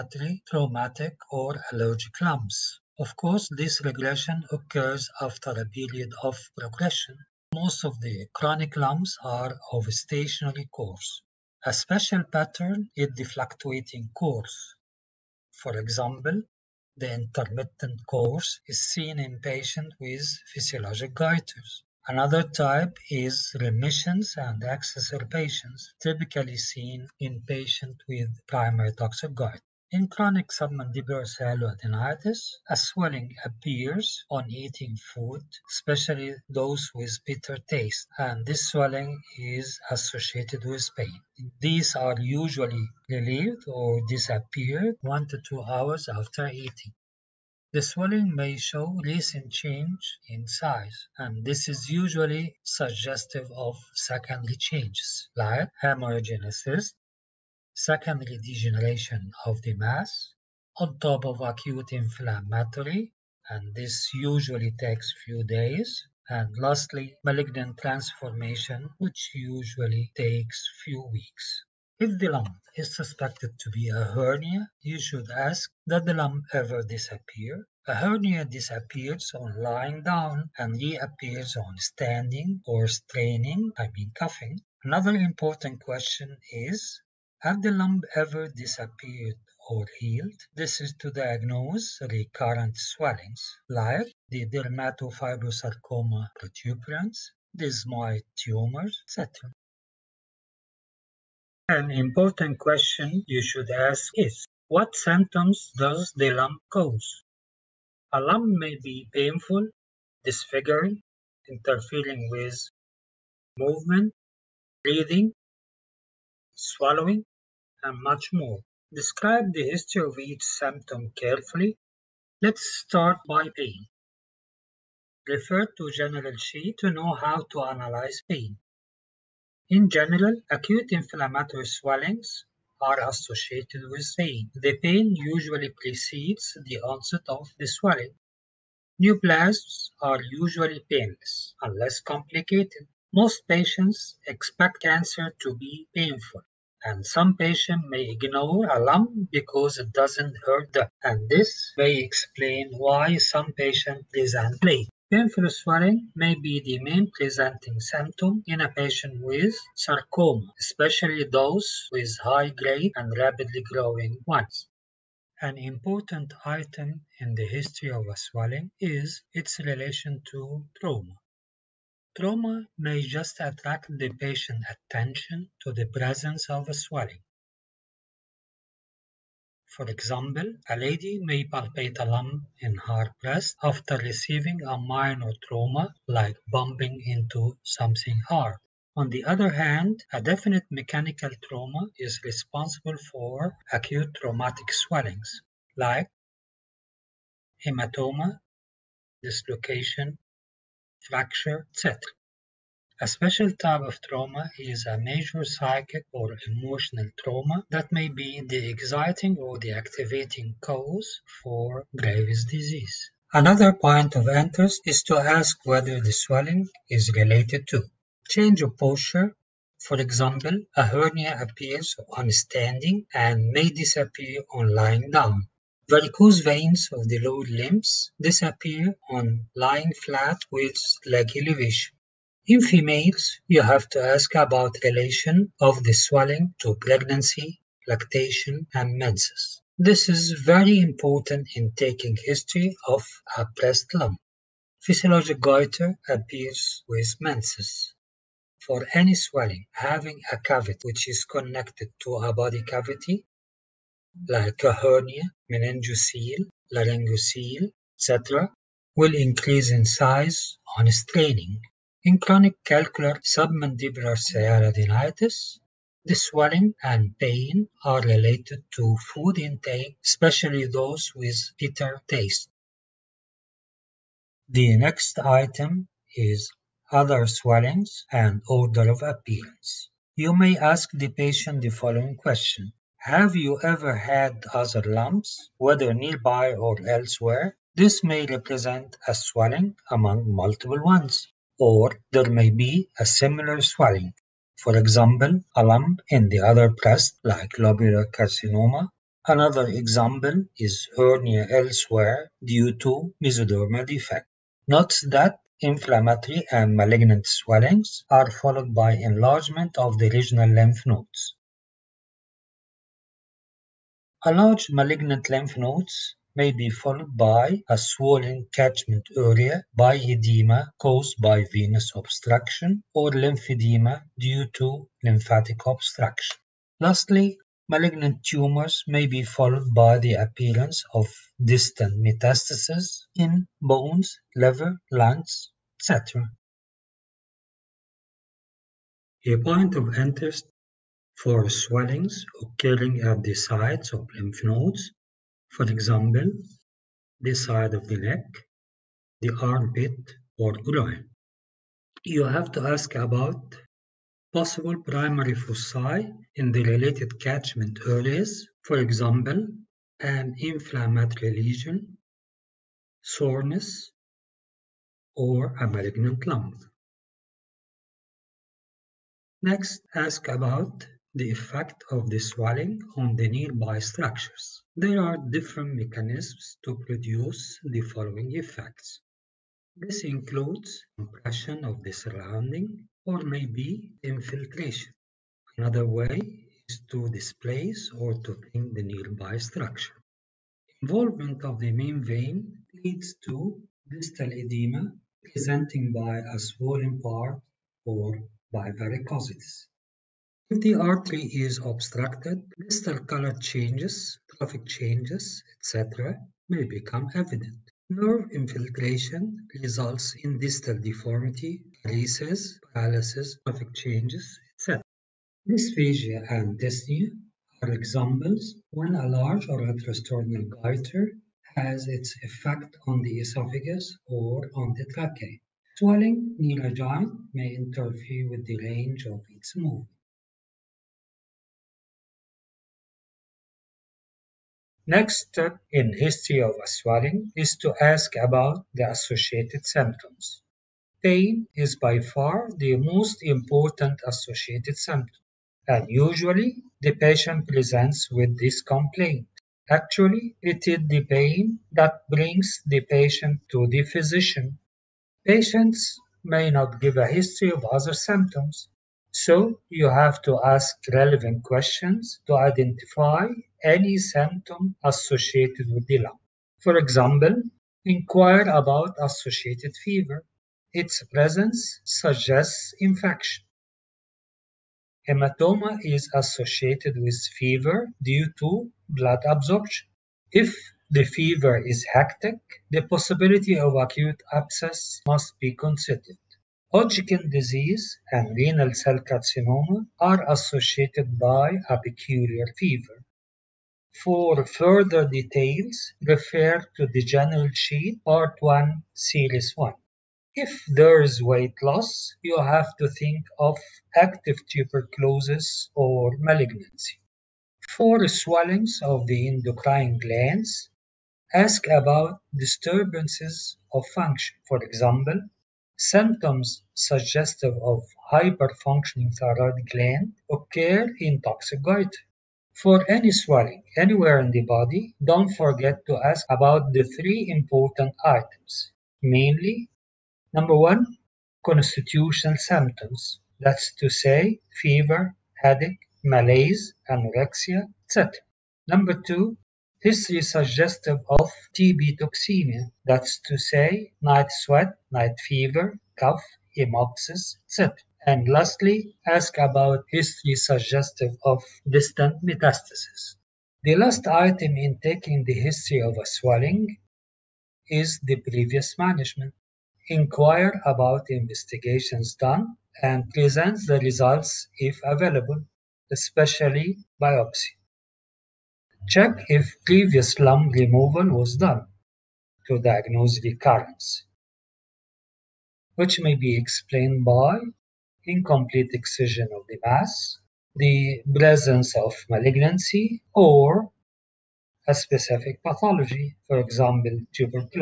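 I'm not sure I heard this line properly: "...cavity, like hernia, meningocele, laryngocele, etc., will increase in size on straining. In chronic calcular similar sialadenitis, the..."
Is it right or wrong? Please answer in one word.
wrong.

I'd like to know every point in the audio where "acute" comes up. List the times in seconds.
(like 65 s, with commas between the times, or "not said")
61 s, 130 s, 193 s, 483 s.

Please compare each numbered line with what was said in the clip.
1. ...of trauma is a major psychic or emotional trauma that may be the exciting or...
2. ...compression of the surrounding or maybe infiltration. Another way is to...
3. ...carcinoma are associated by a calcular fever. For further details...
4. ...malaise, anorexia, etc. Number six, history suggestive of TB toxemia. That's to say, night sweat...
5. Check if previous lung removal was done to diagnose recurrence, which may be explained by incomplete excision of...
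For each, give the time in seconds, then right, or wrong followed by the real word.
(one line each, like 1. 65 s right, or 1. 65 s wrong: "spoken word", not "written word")
1. 203 s right
2. 380 s right
3. 488 s wrong: "peculiar", not "calcular"
4. 536 s wrong: "two", not "six"
5. 568 s right.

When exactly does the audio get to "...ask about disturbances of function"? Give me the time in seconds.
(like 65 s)
511 s.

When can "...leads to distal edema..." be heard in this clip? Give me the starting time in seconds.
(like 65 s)
392 s.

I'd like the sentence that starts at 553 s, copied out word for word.
The last item in taking the history of a swelling is the previous management.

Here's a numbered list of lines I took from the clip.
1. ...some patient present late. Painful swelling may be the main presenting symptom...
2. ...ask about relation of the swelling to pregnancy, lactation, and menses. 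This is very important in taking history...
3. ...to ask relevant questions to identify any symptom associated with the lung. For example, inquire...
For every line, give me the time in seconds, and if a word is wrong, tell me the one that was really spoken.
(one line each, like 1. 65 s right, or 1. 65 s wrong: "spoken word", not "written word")
1. 153 s right
2. 234 s right
3. 460 s right.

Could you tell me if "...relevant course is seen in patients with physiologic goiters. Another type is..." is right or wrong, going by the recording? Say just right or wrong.
wrong.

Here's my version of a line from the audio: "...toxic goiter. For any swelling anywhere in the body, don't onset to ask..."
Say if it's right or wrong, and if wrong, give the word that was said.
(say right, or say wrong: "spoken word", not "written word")
wrong: "forget", not "onset".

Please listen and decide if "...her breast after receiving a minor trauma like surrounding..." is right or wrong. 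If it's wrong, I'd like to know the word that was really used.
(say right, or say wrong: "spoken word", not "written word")
wrong: "bumping", not "surrounding".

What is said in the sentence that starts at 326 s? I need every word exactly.
Lastly, malignant tumors may be followed by the appearance of distant metastases in bones, liver, lungs, etc.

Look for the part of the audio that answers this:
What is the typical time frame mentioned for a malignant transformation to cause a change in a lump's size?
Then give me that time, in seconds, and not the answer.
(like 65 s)
70 s.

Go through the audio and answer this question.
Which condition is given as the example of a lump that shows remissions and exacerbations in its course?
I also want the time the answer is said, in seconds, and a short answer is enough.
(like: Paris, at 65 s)
Primary toxic goiter, at 28 s.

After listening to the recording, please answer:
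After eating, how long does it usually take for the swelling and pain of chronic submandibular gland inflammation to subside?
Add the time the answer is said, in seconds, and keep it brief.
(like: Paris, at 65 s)
1 to 2 hours, at 45 s.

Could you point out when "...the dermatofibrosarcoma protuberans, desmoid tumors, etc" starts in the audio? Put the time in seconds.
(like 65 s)
94 s.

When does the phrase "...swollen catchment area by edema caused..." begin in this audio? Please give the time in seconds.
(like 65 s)
317 s.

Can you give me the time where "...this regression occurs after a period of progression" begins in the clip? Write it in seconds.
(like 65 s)
3 s.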